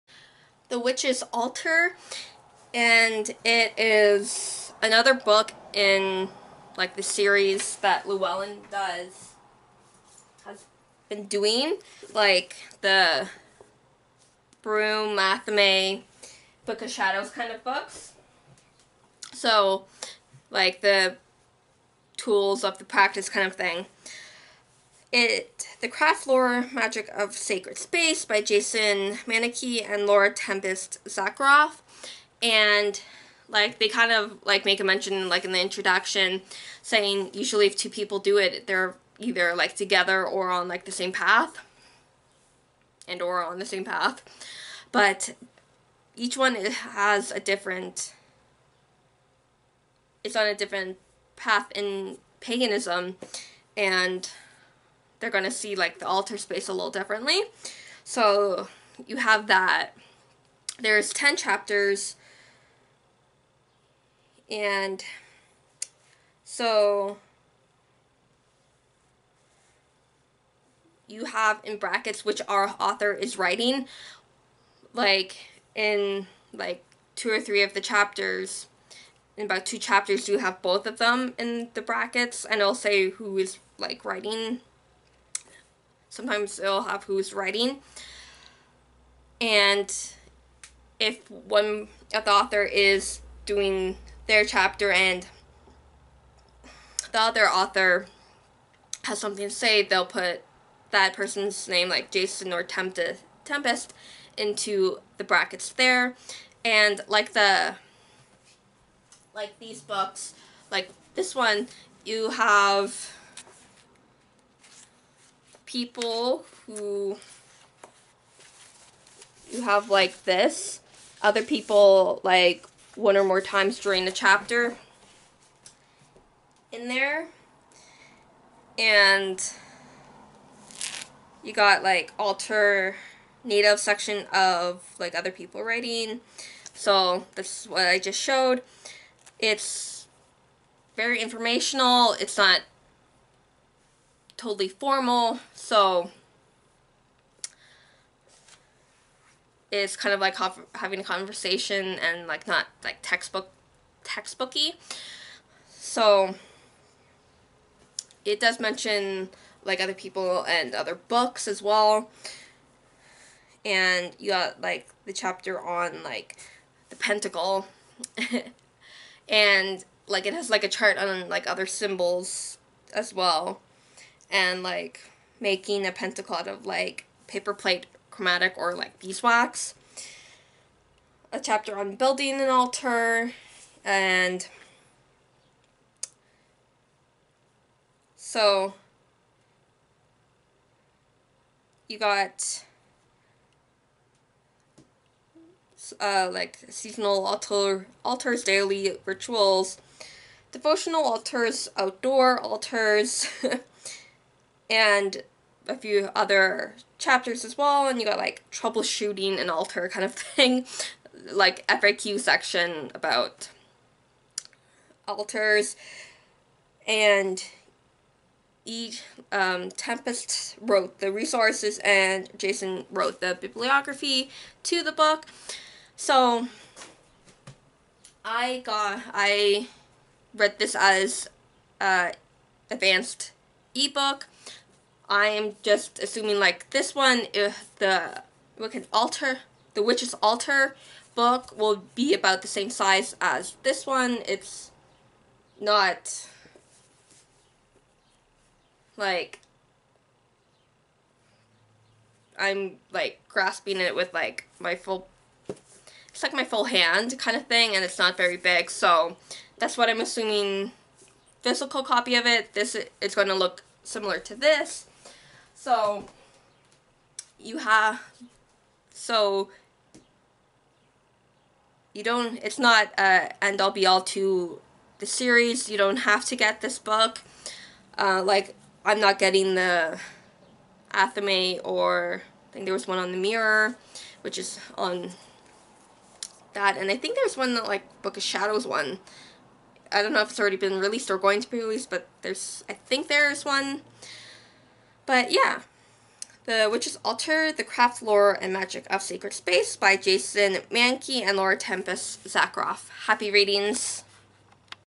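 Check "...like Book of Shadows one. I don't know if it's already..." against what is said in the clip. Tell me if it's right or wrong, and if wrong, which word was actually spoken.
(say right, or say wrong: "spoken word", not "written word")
right.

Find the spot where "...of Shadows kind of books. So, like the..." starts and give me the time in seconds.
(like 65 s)
16 s.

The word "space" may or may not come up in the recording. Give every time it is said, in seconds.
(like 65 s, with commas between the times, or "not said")
27 s, 56 s, 299 s.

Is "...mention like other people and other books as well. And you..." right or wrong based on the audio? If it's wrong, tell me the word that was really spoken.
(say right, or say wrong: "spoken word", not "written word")
right.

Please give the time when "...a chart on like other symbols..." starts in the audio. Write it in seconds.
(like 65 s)
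170 s.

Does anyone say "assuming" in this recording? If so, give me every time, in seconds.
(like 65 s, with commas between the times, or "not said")
236 s, 260 s.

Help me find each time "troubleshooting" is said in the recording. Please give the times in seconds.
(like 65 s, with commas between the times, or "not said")
208 s.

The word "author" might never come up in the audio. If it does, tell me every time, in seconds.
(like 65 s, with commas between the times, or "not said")
72 s, 92 s, 97 s.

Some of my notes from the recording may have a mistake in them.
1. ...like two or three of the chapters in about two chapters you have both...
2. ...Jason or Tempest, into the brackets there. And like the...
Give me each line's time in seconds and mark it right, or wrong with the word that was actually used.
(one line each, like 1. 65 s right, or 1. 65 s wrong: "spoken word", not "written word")
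1. 76 s right
2. 102 s right.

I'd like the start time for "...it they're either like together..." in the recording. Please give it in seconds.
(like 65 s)
38 s.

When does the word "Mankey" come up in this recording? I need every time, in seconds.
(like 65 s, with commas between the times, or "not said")
29 s, 300 s.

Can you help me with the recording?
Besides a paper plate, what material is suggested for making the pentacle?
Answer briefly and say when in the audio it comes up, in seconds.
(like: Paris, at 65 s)
Beeswax, at 178 s.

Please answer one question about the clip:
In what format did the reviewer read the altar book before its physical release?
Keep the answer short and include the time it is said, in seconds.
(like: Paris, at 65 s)
Advanced ebook, at 232 s.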